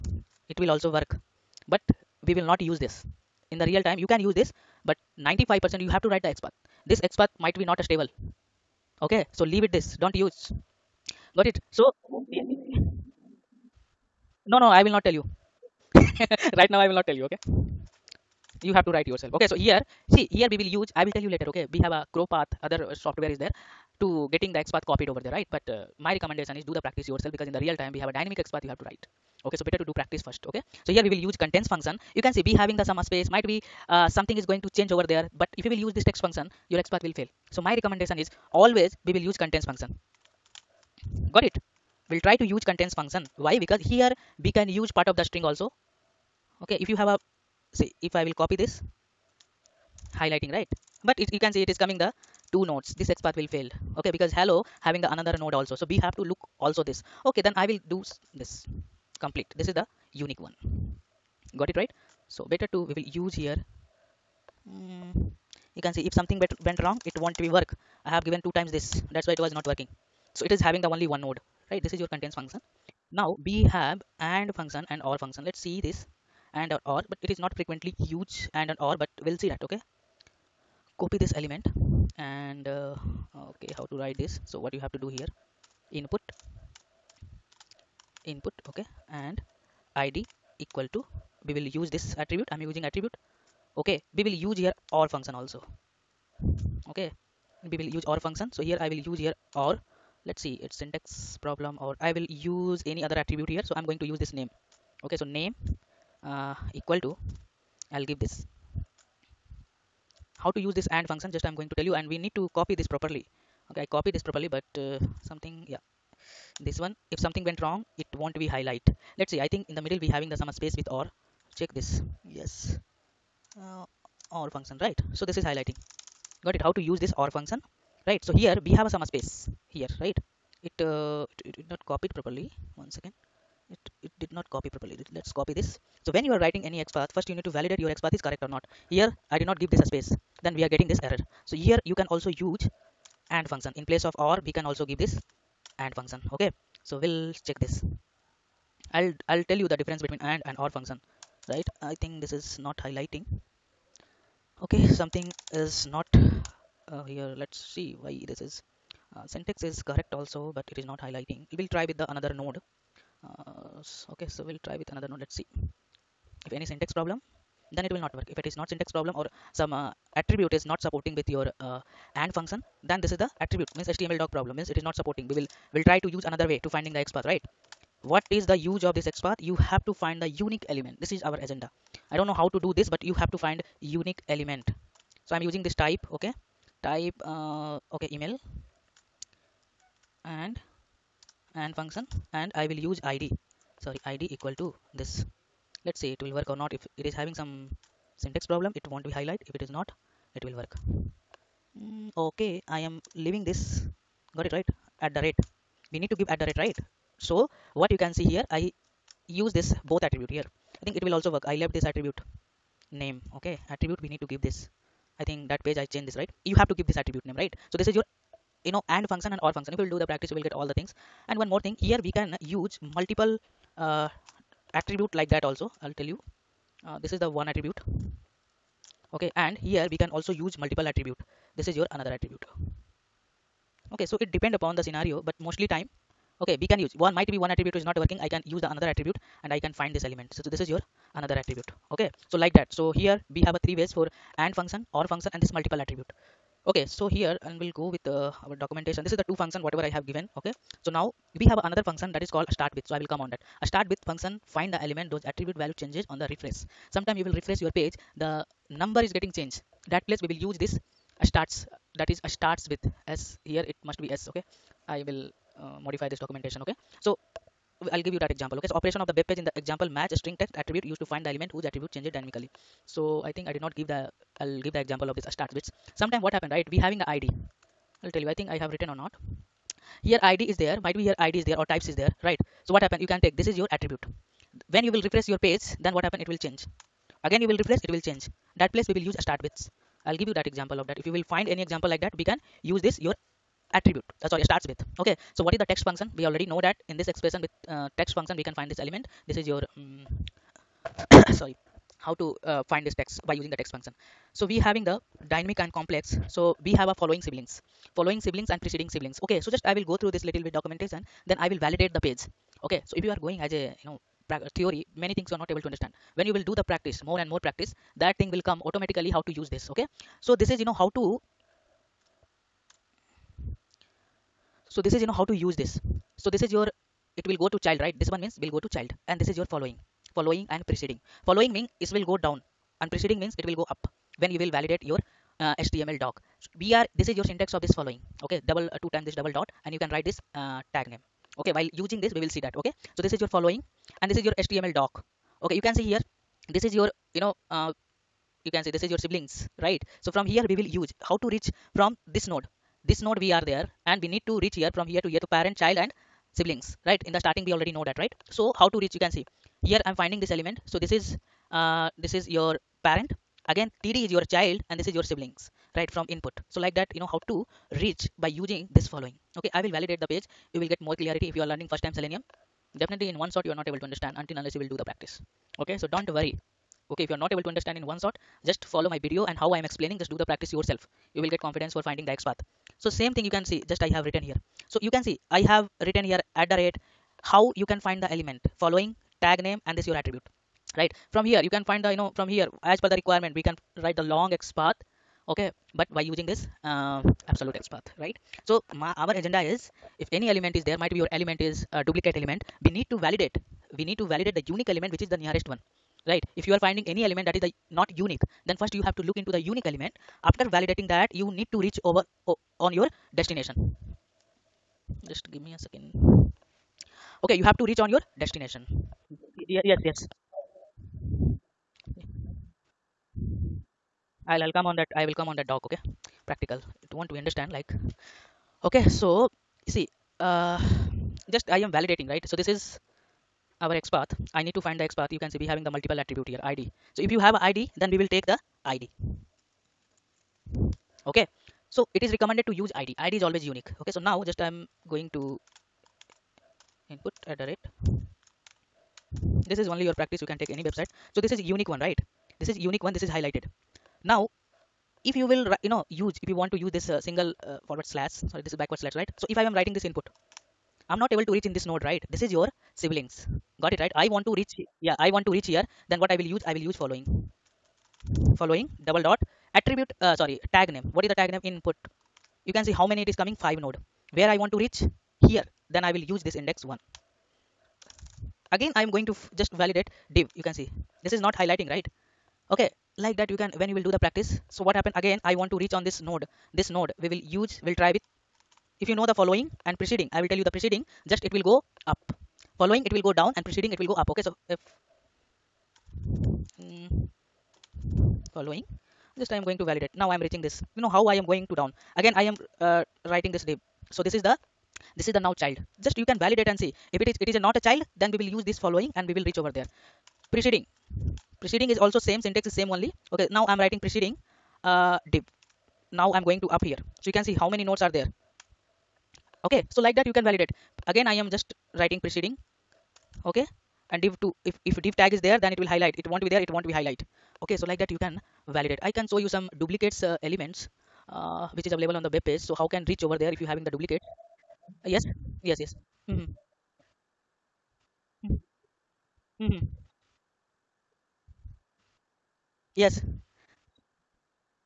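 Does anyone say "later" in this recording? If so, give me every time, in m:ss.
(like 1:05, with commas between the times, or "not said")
0:21.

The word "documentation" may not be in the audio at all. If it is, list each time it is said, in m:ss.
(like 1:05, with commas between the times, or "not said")
4:08, 4:26, 5:10.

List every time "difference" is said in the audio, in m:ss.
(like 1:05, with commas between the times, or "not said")
2:29.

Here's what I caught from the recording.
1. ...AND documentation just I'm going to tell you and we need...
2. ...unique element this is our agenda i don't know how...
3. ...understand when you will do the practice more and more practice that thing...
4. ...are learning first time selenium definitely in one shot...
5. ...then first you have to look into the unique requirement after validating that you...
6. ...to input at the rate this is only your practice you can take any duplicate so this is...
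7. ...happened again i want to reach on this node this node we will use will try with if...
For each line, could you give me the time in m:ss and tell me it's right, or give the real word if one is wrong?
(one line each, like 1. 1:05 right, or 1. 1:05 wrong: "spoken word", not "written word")
1. 1:50 wrong: "function", not "documentation"
2. 3:00 right
3. 5:15 right
4. 6:11 right
5. 6:48 wrong: "element", not "requirement"
6. 7:25 wrong: "website", not "duplicate"
7. 8:04 right.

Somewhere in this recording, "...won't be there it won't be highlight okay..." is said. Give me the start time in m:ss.
8:46.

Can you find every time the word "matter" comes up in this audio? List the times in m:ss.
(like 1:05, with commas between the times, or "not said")
not said.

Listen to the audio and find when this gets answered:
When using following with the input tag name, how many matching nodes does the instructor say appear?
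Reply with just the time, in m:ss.
7:53.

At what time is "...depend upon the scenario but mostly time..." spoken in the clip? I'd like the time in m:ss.
3:54.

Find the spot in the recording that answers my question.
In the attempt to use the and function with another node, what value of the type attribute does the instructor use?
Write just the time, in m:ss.
3:08.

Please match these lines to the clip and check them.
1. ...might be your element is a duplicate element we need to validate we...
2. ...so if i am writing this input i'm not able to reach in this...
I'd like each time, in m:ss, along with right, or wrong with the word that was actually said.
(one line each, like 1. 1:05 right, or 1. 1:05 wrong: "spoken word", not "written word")
1. 6:40 right
2. 7:39 right.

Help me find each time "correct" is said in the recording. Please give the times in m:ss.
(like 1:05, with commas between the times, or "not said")
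2:18, 2:39.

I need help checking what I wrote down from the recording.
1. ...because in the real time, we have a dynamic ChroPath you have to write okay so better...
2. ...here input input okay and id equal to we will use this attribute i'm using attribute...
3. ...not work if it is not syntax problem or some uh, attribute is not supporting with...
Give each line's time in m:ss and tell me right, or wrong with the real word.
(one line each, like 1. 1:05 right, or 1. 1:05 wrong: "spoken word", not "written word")
1. 0:27 wrong: "XPath", not "ChroPath"
2. 1:25 right
3. 2:48 right.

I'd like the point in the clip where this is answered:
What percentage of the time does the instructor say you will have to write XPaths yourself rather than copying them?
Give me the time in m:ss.
0:05.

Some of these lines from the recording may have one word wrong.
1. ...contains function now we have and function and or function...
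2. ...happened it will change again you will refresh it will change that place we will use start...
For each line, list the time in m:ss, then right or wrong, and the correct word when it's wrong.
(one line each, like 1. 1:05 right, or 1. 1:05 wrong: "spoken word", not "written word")
1. 1:12 right
2. 4:46 right.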